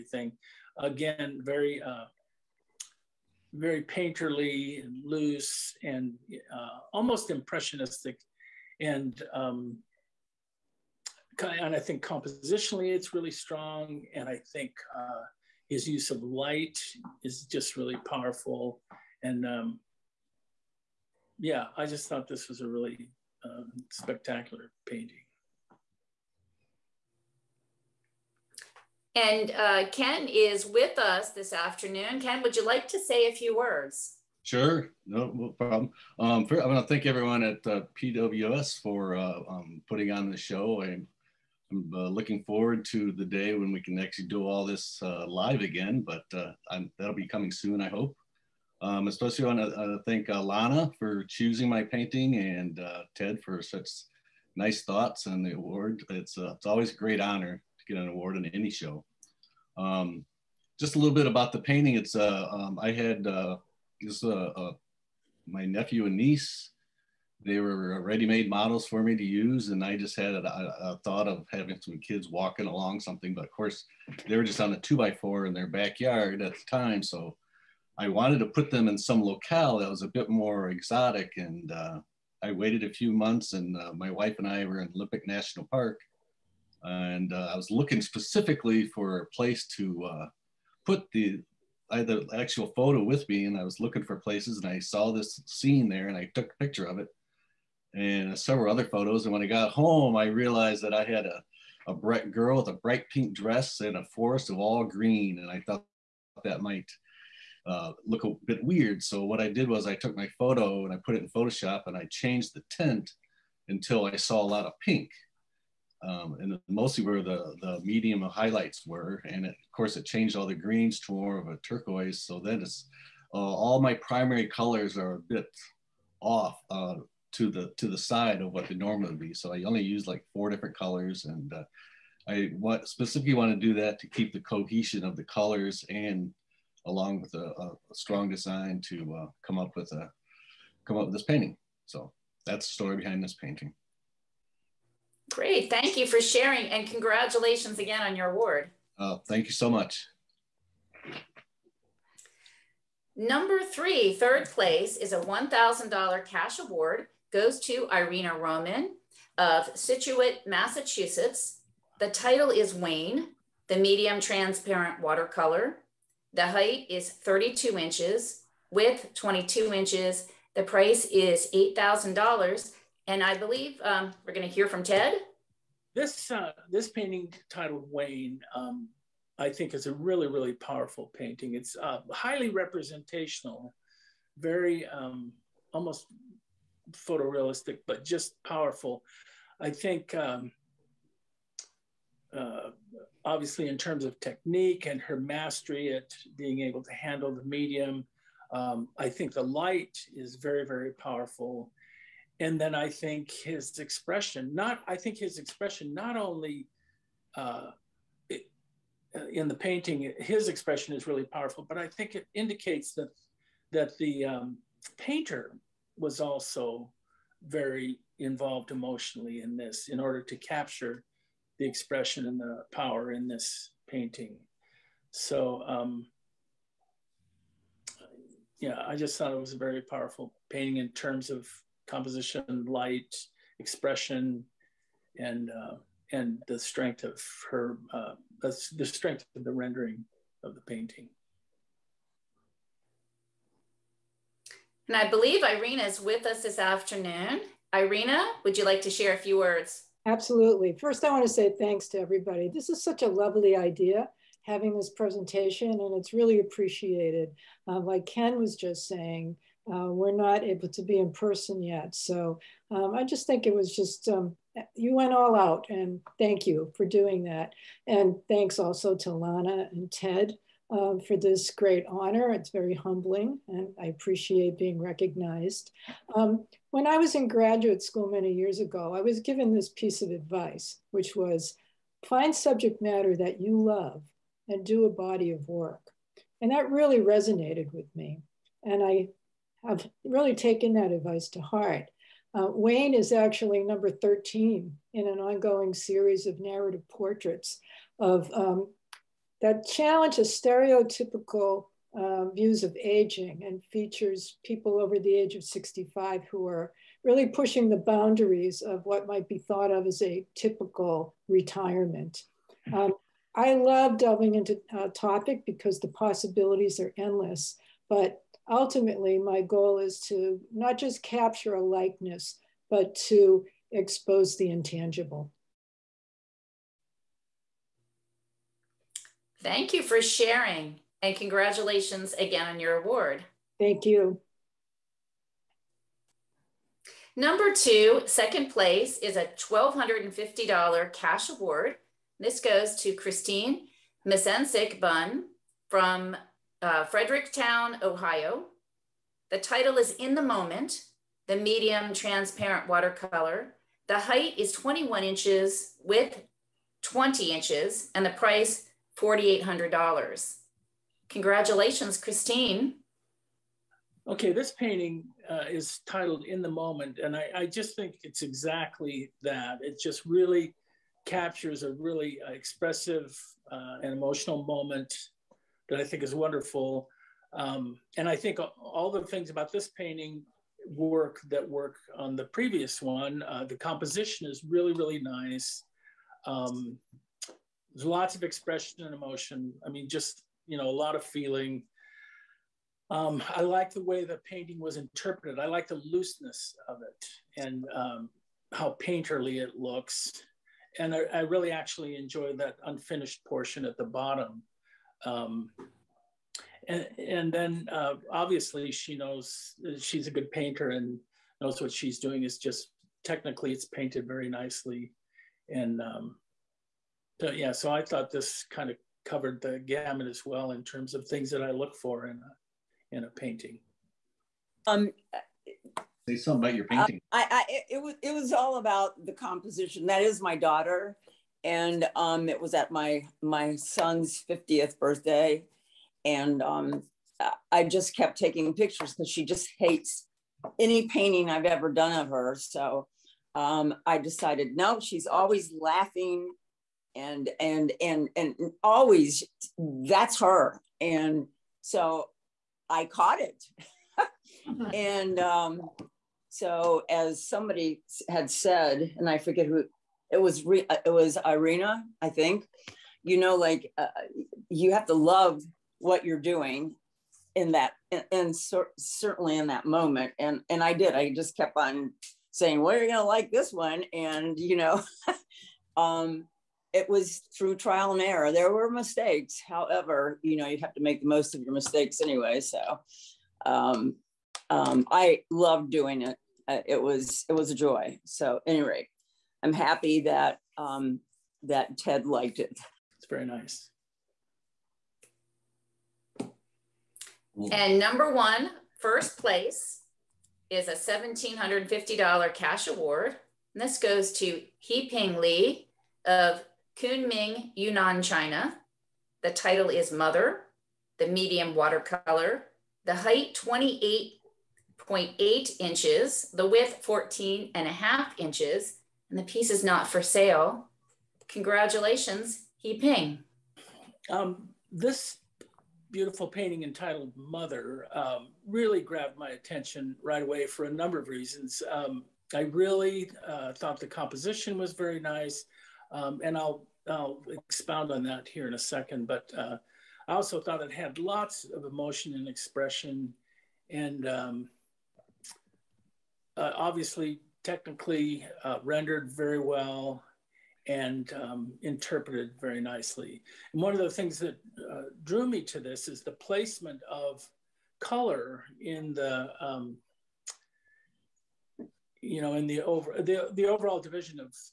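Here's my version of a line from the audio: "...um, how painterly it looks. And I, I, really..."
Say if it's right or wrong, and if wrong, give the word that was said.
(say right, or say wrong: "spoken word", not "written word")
right.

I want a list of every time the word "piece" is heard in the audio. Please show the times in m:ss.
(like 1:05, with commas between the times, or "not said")
4:39, 8:39.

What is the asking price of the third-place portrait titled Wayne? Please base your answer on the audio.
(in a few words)
$8,000.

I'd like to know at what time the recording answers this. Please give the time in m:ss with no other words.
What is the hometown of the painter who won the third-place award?
2:39.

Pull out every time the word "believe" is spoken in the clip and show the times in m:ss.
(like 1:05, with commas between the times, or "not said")
2:53, 4:05.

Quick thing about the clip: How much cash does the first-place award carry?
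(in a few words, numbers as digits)
$1,750.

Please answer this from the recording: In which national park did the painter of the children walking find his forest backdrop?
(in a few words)
Olympic National Park.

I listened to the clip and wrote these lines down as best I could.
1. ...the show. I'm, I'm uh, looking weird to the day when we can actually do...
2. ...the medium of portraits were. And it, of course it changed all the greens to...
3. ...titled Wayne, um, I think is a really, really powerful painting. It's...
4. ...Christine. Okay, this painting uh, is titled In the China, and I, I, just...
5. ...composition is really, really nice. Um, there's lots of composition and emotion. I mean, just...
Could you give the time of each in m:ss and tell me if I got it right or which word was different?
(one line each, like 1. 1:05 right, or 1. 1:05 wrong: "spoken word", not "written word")
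1. 0:40 wrong: "forward", not "weird"
2. 1:57 wrong: "highlights", not "portraits"
3. 2:57 right
4. 6:01 wrong: "Moment", not "China"
5. 6:23 wrong: "expression", not "composition".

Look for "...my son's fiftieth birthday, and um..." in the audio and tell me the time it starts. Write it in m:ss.
7:13.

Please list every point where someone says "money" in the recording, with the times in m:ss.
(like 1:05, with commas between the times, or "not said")
not said.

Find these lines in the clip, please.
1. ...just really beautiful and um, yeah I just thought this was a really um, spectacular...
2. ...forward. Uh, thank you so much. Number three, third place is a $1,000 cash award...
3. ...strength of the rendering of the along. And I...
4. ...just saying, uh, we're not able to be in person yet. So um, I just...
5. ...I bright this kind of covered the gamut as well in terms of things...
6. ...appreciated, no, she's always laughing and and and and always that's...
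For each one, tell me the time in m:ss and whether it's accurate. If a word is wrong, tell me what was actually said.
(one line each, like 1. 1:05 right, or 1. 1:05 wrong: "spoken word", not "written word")
1. 0:17 wrong: "powerful", not "beautiful"
2. 2:28 wrong: "award", not "forward"
3. 3:58 wrong: "painting", not "along"
4. 4:18 right
5. 6:57 wrong: "thought", not "bright"
6. 7:23 wrong: "decided", not "appreciated".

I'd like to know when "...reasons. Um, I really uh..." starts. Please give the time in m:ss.
8:51.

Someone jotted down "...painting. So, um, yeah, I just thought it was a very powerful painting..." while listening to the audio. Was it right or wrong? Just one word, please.
right.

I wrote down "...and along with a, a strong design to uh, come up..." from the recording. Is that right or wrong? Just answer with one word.
right.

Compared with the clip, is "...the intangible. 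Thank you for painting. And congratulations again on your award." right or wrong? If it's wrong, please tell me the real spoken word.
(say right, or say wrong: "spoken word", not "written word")
wrong: "sharing", not "painting".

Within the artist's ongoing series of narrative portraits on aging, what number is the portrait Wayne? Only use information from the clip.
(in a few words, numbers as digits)
13.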